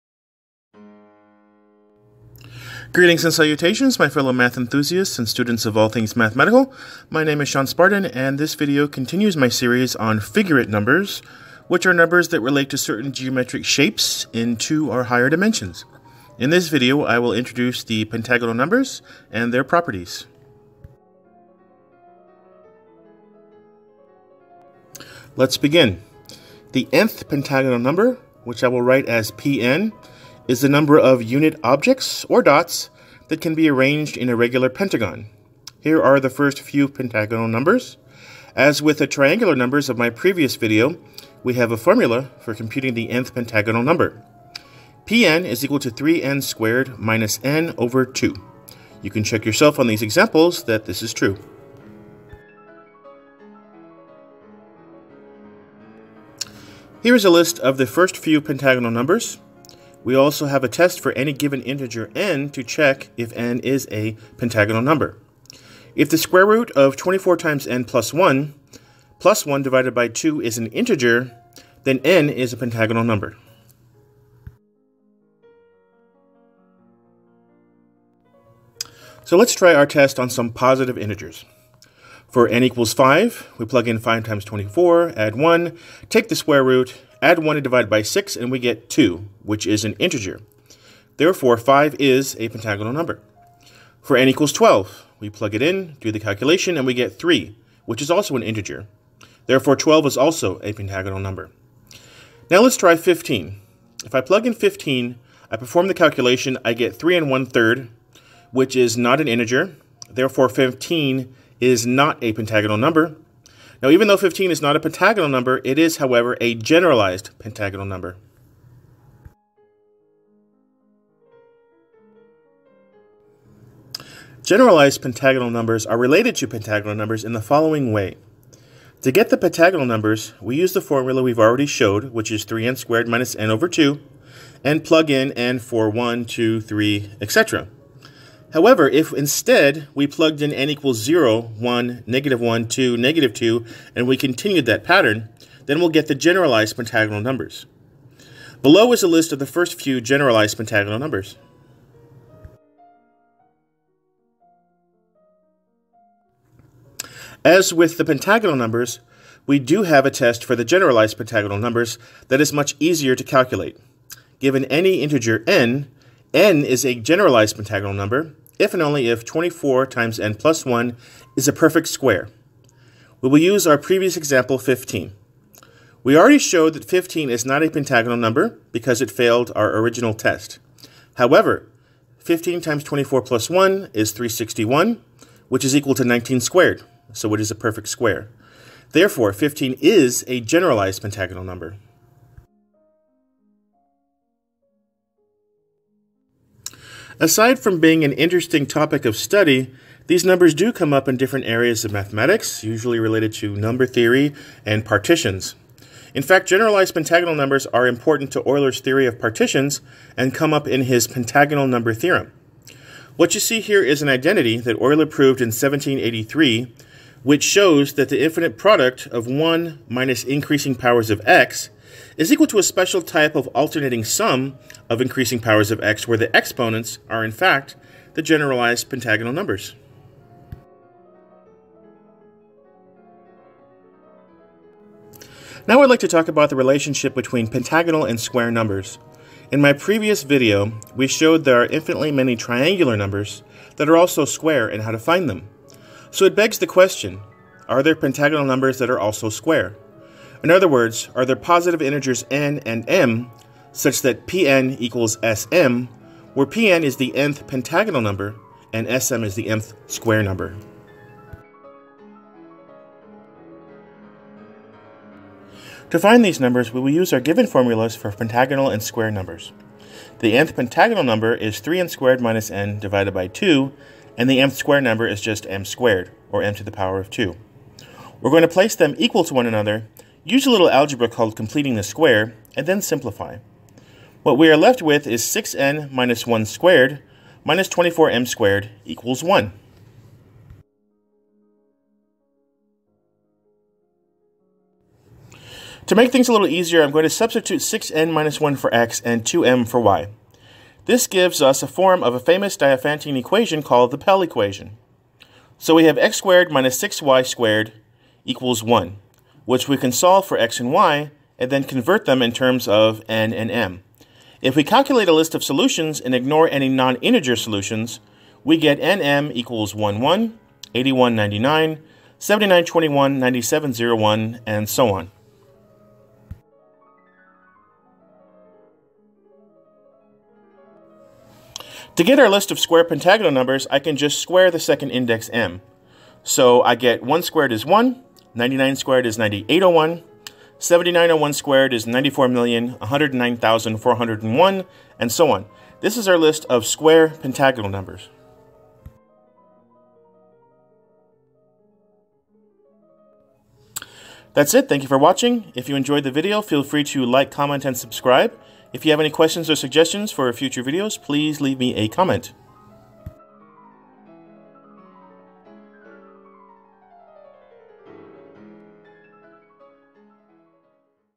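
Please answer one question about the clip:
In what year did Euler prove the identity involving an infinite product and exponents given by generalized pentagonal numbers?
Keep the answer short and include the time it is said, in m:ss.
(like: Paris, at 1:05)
1783, at 3:35.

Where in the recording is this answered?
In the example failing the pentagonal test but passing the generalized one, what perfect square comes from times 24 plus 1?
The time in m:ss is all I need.
3:04.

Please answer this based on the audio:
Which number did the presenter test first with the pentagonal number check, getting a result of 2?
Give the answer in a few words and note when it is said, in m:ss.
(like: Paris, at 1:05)
5, at 1:22.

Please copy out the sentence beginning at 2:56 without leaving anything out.
We already showed that 15 is not a pentagonal number because it failed our original test.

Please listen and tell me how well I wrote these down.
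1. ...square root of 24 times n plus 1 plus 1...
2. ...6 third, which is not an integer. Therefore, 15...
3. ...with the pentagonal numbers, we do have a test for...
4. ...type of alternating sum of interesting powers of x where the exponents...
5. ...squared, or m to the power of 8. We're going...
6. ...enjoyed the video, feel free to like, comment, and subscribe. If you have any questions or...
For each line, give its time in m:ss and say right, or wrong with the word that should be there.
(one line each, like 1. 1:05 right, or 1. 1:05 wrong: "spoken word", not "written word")
1. 1:06 right
2. 1:47 wrong: "1", not "6"
3. 2:37 right
4. 3:43 wrong: "increasing", not "interesting"
5. 4:35 wrong: "2", not "8"
6. 5:55 right.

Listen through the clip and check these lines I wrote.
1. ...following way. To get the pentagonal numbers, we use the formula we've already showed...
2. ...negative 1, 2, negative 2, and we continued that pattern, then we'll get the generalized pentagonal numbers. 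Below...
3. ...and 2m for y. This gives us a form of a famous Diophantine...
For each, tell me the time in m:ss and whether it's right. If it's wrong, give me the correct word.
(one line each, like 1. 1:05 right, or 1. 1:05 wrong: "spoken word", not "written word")
1. 2:07 right
2. 2:22 right
3. 4:59 right.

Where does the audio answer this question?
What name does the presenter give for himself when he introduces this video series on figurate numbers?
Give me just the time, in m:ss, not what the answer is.
0:07.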